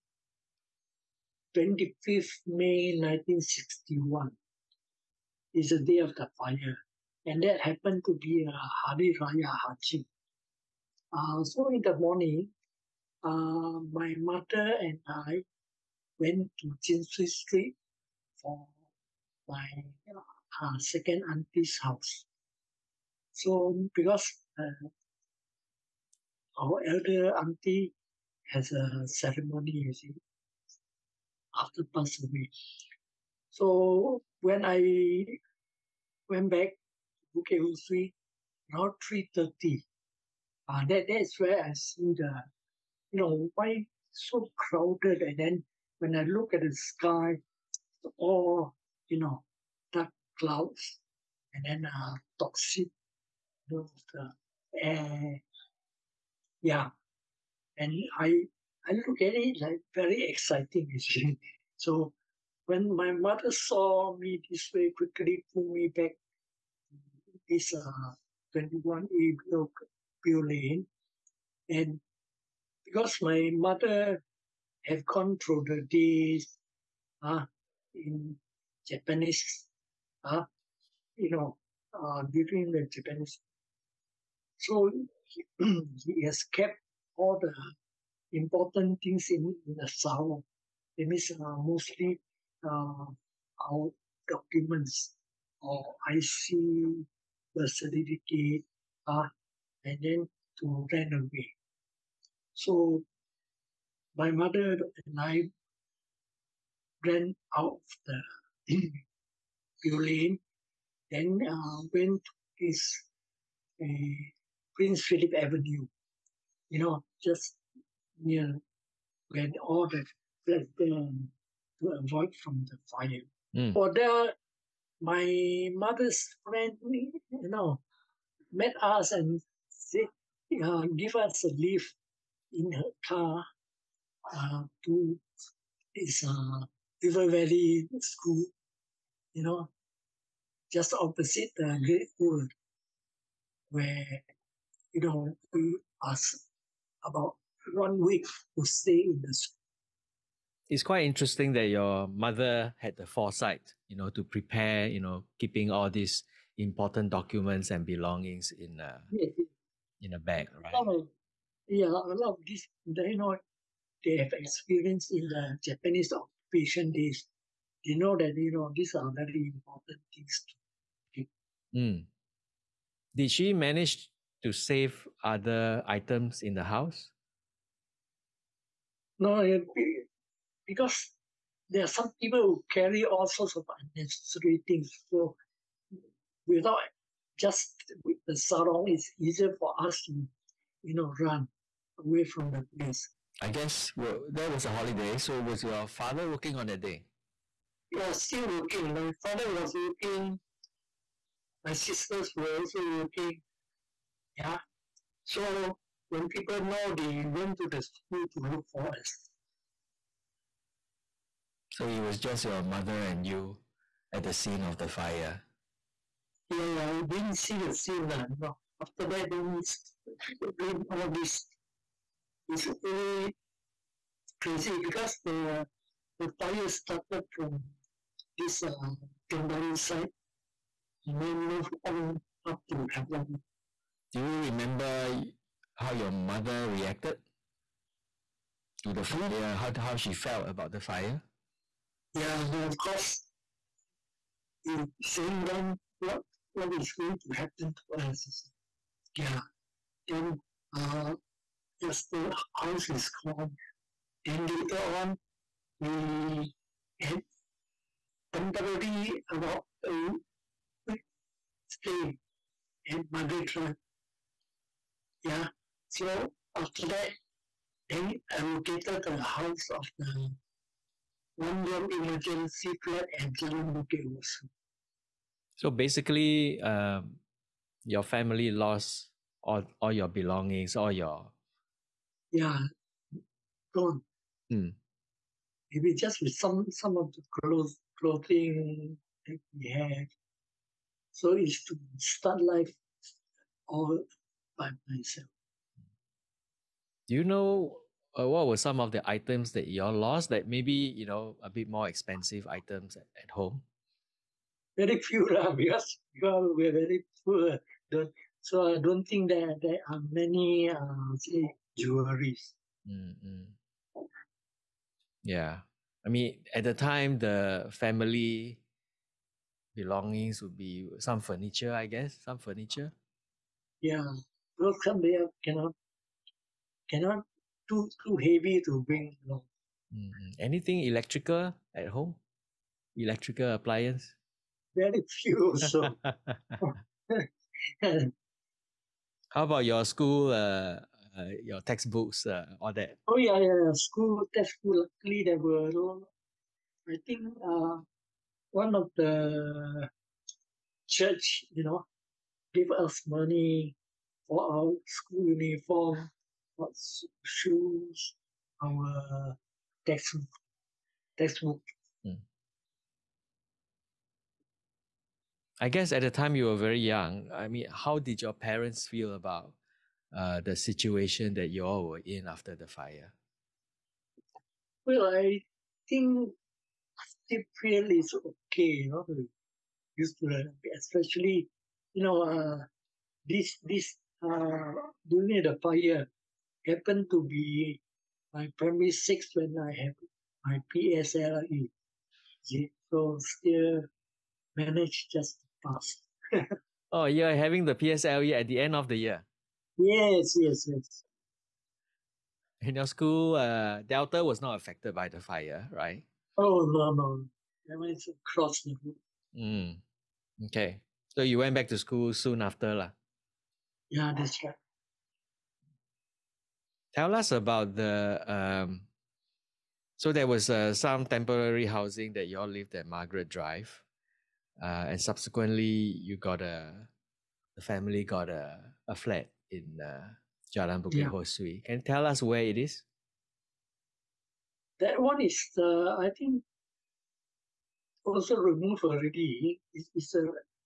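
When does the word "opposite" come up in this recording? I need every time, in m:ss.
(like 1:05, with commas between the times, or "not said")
2:20.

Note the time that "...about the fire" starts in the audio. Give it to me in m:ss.
4:00.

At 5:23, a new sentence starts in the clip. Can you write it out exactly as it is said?
Yeah, well, some they cannot, cannot too too heavy to bring along.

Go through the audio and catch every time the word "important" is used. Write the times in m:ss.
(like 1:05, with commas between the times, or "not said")
1:28, 2:36, 2:49.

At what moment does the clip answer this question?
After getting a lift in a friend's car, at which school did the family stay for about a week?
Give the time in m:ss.
2:17.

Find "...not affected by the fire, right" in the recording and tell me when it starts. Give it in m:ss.
6:44.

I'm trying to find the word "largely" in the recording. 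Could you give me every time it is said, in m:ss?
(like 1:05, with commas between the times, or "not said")
not said.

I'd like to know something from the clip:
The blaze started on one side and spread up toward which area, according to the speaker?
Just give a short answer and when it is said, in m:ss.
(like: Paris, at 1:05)
Havelock, at 3:52.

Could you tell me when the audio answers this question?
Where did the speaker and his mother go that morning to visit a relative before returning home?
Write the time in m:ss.
0:16.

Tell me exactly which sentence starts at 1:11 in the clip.
And because my mother had gone through the days uh, in Japanese, uh, you know, uh, during the Japanese.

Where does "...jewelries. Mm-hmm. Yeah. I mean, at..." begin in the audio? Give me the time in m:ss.
5:11.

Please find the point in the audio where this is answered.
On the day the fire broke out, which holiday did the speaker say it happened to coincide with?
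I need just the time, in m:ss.
0:08.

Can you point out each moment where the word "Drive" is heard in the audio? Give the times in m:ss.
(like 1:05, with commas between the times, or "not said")
4:23, 7:03.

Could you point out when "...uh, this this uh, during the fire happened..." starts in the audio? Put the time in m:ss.
6:22.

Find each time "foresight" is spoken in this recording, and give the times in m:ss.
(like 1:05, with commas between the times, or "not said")
2:33.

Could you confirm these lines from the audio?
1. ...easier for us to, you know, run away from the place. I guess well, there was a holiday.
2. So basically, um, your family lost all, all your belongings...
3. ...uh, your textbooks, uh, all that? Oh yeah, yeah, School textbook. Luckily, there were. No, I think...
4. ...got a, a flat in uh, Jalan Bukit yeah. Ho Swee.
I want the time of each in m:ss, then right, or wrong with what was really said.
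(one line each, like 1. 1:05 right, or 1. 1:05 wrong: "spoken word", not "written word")
1. 3:09 right
2. 4:35 right
3. 5:41 right
4. 7:08 right.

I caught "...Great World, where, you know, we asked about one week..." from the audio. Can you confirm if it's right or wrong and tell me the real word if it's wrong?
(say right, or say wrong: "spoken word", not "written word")
right.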